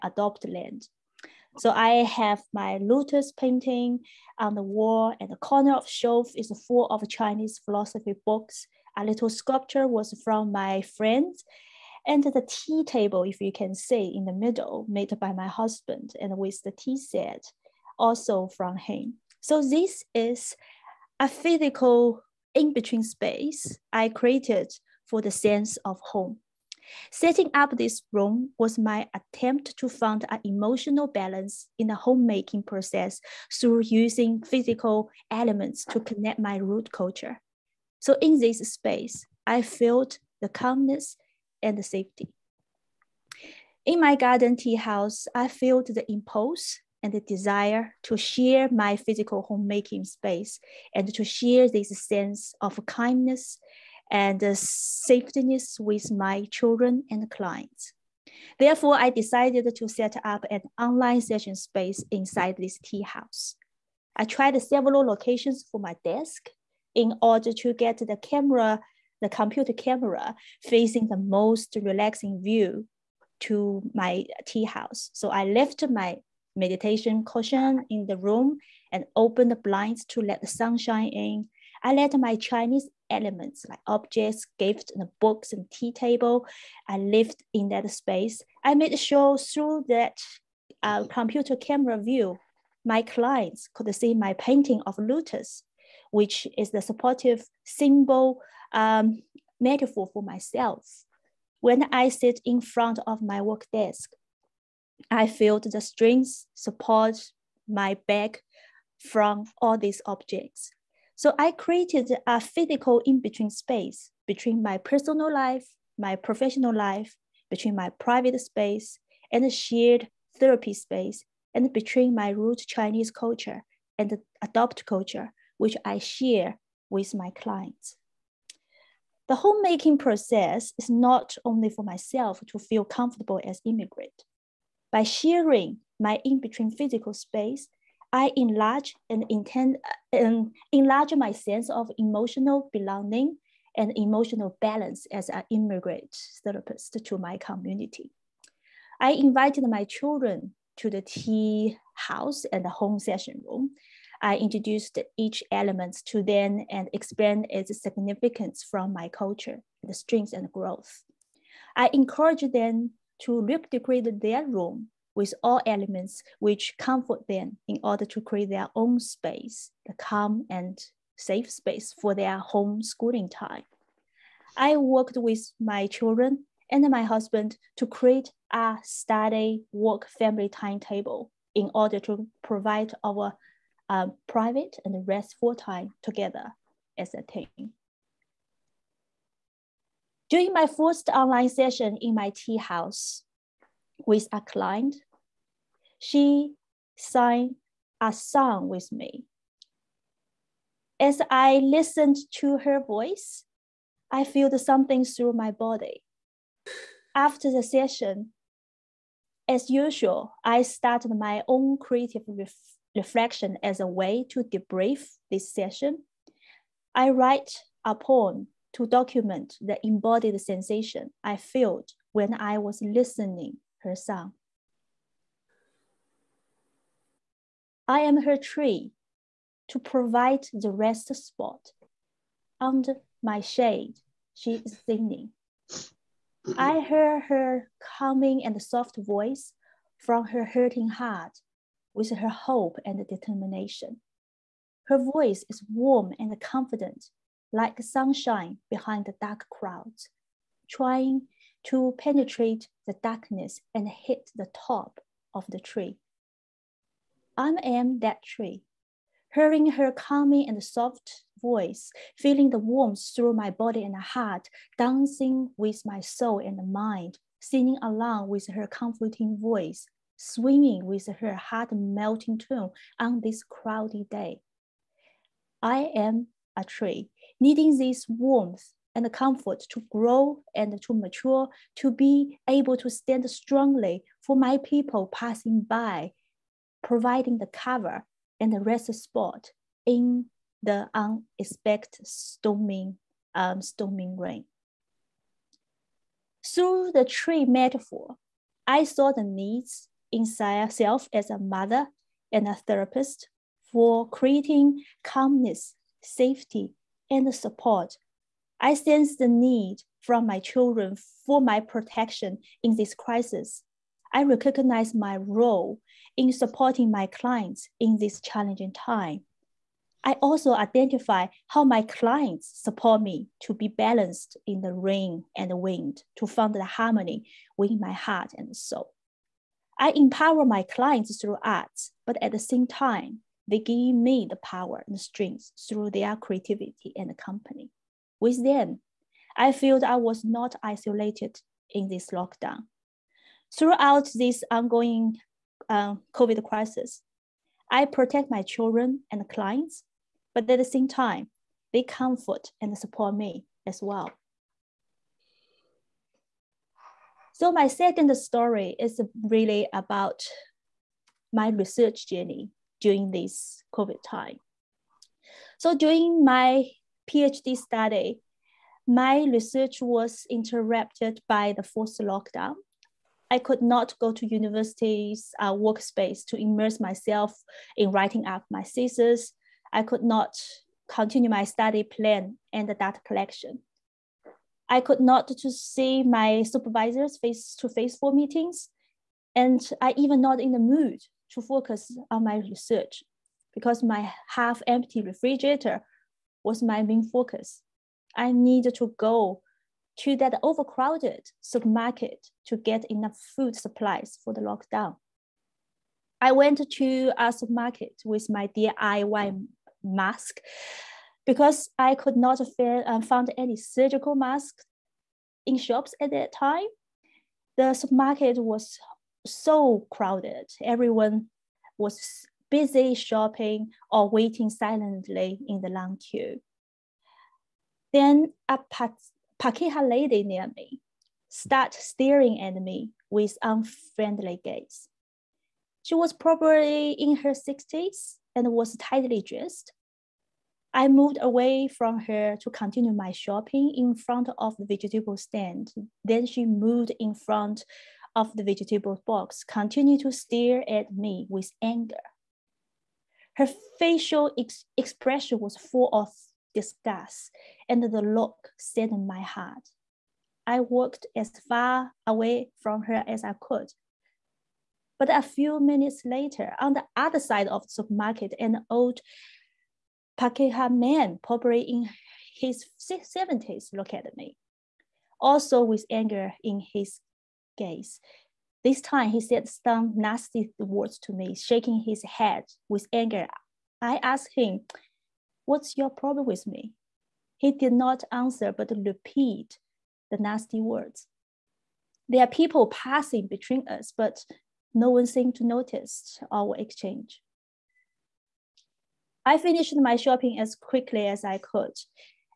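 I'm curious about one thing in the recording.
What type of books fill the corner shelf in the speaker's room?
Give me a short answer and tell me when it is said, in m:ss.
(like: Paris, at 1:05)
Chinese philosophy books, at 0:07.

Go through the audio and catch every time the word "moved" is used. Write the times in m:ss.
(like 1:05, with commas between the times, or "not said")
7:20, 7:26.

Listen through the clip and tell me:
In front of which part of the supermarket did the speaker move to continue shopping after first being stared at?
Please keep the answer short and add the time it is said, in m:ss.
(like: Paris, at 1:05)
Vegetable stand, at 7:24.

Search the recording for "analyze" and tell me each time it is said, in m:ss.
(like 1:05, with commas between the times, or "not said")
not said.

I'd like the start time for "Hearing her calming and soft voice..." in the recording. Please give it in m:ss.
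4:19.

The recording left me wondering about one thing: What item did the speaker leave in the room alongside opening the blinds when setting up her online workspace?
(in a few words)
Meditation cushion.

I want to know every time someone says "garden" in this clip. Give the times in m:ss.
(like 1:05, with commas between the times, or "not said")
0:44.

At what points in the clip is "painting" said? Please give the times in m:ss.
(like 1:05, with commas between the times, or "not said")
0:03, 1:34.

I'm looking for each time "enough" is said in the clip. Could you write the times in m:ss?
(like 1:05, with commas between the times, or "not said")
6:42.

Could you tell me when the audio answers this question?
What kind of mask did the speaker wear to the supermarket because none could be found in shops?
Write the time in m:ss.
6:48.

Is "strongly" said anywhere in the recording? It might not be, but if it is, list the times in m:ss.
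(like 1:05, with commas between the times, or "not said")
4:43.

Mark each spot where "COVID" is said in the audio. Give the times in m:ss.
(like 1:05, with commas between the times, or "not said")
5:46, 6:03.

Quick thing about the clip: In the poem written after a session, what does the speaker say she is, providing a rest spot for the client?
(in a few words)
A tree.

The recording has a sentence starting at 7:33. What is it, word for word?
Her facial ex expression was full of disgust, and the look saddened my heart.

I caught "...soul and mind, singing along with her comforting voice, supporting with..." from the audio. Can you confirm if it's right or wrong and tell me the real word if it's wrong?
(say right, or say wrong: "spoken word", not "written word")
wrong: "swimming", not "supporting".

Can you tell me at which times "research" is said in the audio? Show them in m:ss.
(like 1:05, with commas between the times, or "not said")
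6:01, 6:09, 6:32.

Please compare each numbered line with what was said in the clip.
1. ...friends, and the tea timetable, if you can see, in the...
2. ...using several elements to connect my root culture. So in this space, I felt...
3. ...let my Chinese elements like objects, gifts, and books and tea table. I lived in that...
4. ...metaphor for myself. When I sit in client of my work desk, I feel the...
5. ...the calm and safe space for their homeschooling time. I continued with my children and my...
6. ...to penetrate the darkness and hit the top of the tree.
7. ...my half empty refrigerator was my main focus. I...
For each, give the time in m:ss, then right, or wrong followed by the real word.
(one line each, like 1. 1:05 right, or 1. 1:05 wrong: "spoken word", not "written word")
1. 0:10 wrong: "table", not "timetable"
2. 0:33 wrong: "physical", not "several"
3. 1:21 right
4. 1:39 wrong: "front", not "client"
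5. 2:49 wrong: "worked", not "continued"
6. 4:11 right
7. 6:33 right.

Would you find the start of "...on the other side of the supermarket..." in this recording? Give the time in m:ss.
7:46.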